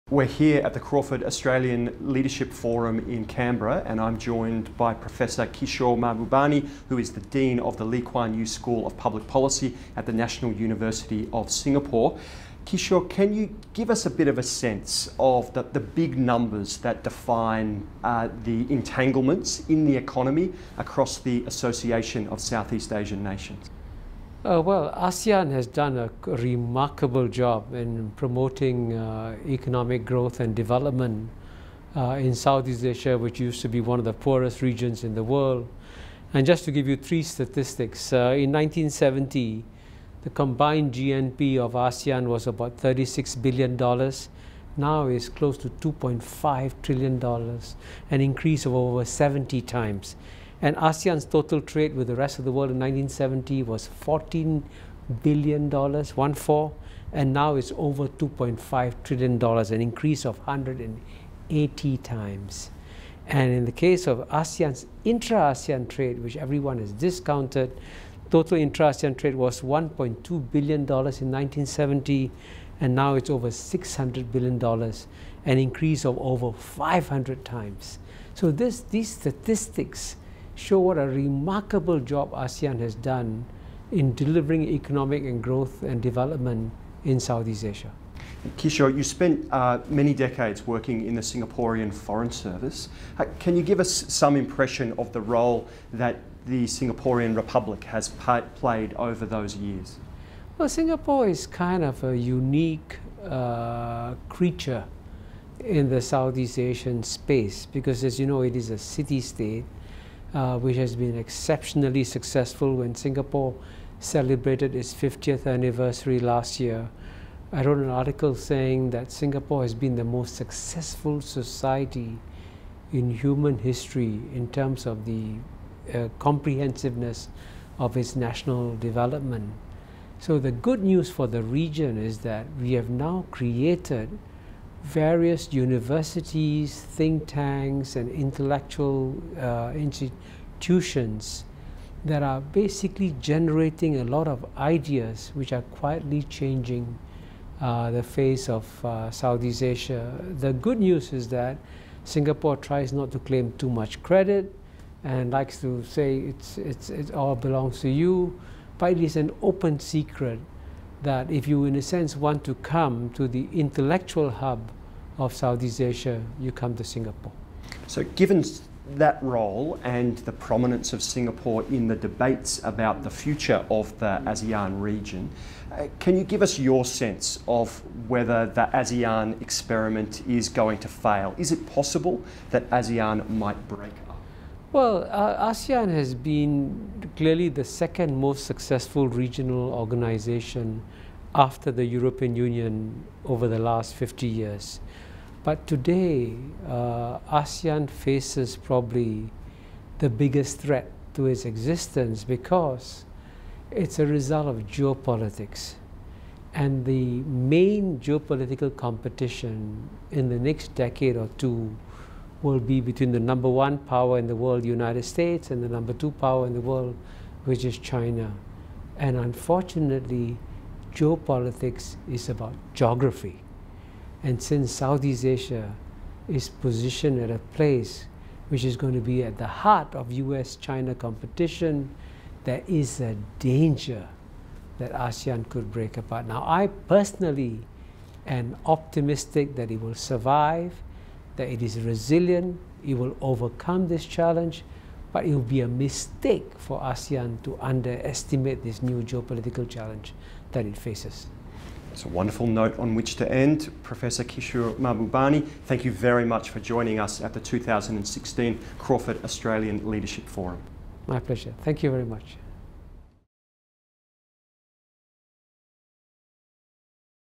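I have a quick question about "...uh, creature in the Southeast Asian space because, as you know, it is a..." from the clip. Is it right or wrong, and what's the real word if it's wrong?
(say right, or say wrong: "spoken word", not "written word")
right.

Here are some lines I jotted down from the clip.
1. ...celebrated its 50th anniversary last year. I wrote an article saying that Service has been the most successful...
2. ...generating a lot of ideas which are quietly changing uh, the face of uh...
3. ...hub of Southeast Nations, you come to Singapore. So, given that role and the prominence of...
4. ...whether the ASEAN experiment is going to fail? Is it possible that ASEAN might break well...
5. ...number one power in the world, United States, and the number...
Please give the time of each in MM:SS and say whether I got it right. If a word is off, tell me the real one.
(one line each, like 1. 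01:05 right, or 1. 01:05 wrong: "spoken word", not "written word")
1. 01:53 wrong: "Singapore", not "Service"
2. 02:23 right
3. 02:44 wrong: "Asia", not "Nations"
4. 02:58 right
5. 03:33 right.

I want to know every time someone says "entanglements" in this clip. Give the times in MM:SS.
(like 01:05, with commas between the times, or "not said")
00:18.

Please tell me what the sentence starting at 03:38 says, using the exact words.
And unfortunately, geopolitics is about geography.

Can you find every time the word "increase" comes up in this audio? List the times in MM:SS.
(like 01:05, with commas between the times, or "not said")
00:48, 00:59, 01:15.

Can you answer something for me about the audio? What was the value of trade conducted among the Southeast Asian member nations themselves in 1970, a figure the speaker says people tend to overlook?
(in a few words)
$1.2 billion.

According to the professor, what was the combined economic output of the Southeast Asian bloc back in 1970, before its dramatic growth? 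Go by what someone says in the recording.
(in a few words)
$36 billion.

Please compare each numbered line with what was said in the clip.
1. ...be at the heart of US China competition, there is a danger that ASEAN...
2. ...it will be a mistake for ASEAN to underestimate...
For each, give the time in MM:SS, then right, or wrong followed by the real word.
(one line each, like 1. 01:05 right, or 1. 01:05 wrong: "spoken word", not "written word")
1. 03:48 right
2. 04:05 right.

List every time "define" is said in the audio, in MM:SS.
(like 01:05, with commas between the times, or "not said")
00:17.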